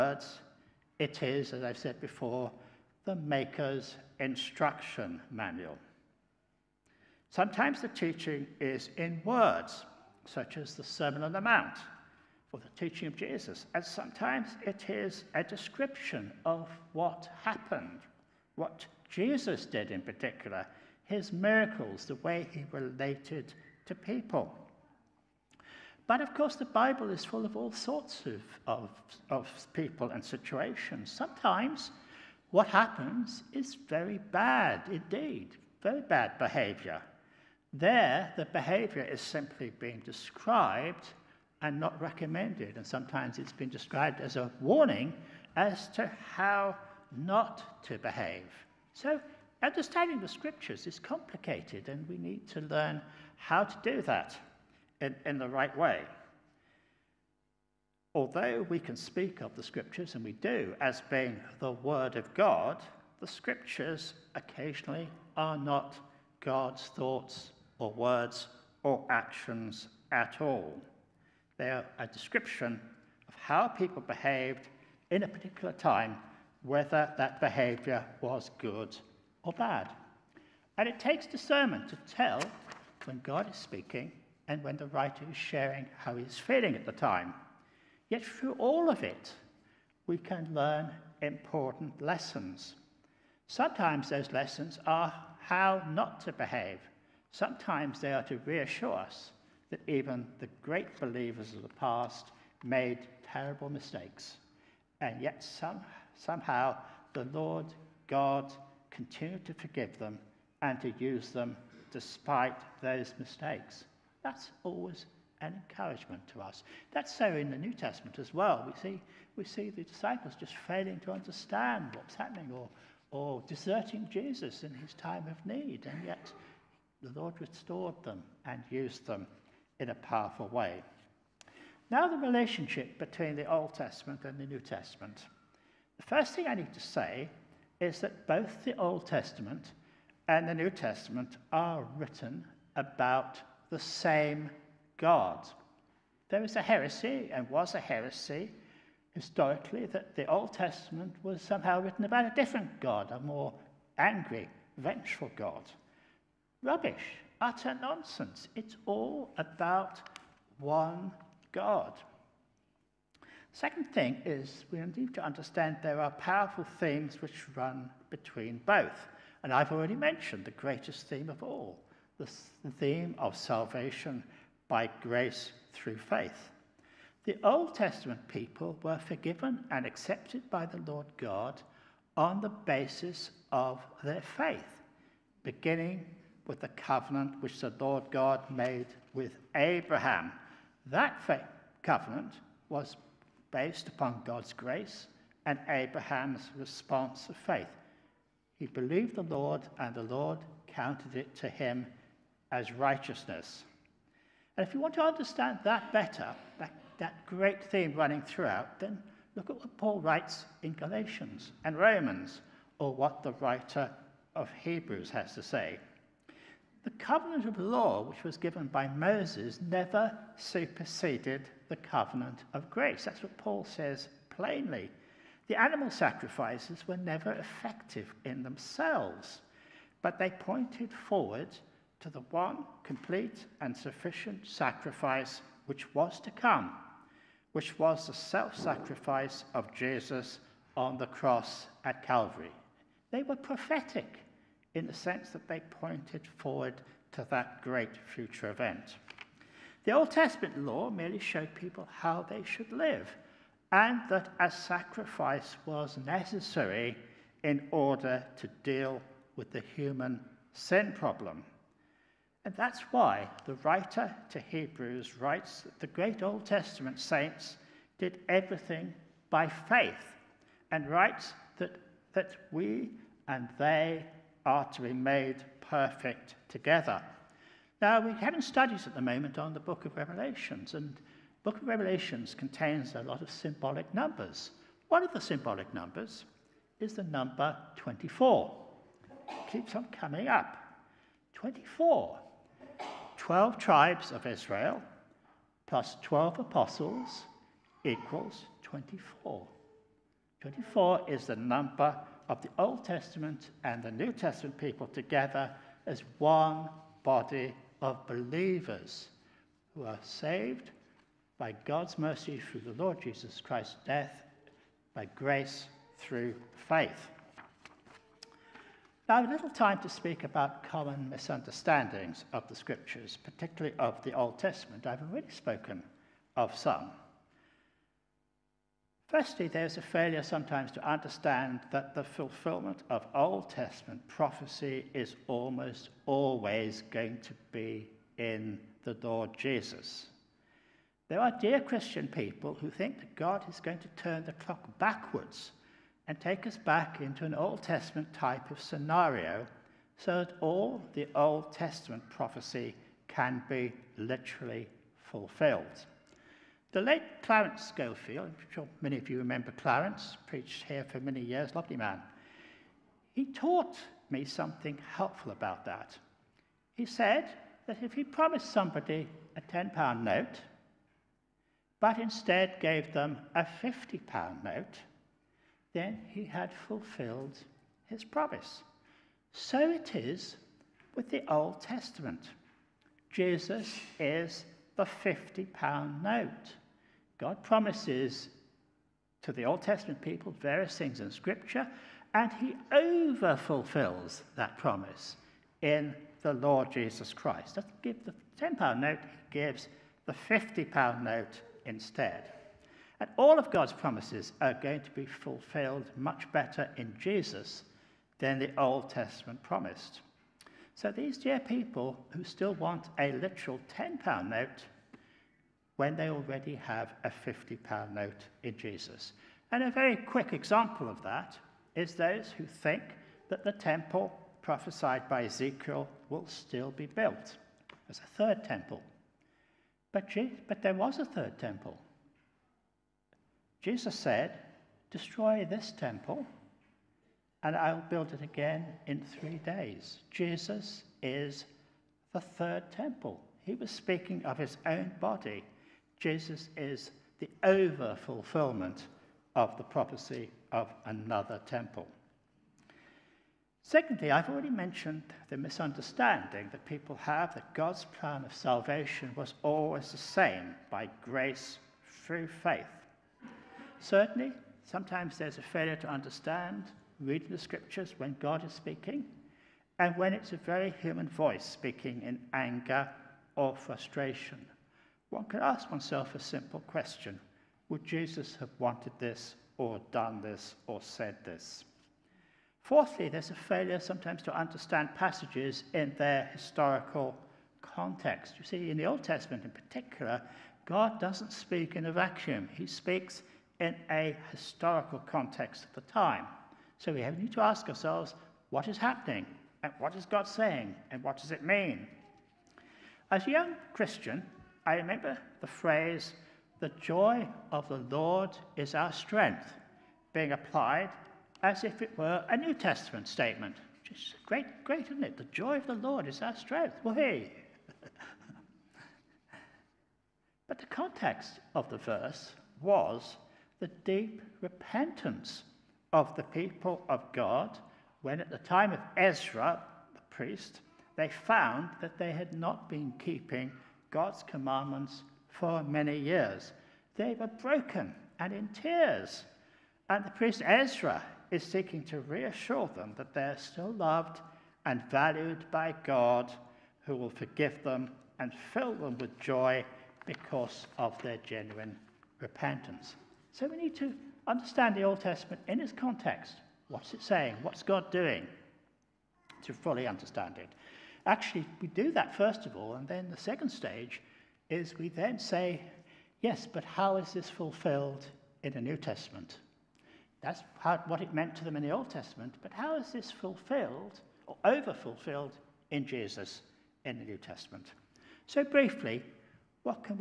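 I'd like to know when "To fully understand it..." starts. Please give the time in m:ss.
9:19.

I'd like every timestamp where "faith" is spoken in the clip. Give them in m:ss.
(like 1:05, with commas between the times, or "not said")
2:55, 3:04, 3:17, 4:29, 5:16, 7:42.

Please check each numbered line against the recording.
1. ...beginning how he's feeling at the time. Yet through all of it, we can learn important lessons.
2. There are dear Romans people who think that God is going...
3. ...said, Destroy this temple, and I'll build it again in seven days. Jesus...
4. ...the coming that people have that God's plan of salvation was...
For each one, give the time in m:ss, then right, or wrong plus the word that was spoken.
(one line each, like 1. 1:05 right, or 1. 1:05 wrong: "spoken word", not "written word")
1. 1:25 wrong: "sharing", not "beginning"
2. 5:41 wrong: "Christian", not "Romans"
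3. 7:13 wrong: "three", not "seven"
4. 7:35 wrong: "misunderstanding", not "coming".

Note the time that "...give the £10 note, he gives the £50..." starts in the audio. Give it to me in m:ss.
6:37.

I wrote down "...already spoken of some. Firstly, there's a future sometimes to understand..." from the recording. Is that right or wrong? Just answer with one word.
wrong.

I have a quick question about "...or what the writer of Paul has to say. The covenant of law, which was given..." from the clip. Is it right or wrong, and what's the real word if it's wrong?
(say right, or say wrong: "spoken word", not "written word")
wrong: "Hebrews", not "Paul".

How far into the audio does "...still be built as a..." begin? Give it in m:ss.
7:06.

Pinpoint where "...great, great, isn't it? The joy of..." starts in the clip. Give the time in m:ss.
8:34.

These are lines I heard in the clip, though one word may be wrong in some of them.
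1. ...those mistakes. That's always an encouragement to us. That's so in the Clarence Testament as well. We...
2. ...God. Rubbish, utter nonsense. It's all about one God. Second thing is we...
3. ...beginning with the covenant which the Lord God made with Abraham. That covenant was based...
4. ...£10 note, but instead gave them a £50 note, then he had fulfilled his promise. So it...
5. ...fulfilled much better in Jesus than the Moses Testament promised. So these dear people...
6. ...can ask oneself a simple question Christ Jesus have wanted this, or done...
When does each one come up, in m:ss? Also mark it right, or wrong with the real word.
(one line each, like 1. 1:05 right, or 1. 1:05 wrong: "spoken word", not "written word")
1. 1:52 wrong: "New", not "Clarence"
2. 2:35 right
3. 3:05 right
4. 6:09 right
5. 6:45 wrong: "Old", not "Moses"
6. 7:55 wrong: "Would", not "Christ".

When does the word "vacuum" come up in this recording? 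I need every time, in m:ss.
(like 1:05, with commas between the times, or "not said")
8:11.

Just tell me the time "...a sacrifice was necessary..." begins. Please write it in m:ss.
4:14.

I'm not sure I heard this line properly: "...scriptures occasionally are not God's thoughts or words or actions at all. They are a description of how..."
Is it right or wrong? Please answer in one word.
right.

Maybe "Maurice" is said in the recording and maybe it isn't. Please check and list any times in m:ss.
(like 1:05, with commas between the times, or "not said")
not said.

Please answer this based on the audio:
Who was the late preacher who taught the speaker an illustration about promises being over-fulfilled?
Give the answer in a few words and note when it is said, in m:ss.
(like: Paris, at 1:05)
Clarence Schofield, at 5:57.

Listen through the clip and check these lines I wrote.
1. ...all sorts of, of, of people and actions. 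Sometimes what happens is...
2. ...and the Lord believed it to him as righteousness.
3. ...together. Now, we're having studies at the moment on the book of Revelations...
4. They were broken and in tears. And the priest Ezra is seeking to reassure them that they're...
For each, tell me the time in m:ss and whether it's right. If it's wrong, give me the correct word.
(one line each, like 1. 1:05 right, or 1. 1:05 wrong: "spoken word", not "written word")
1. 0:27 wrong: "situations", not "actions"
2. 3:19 wrong: "counted", not "believed"
3. 4:36 right
4. 8:56 right.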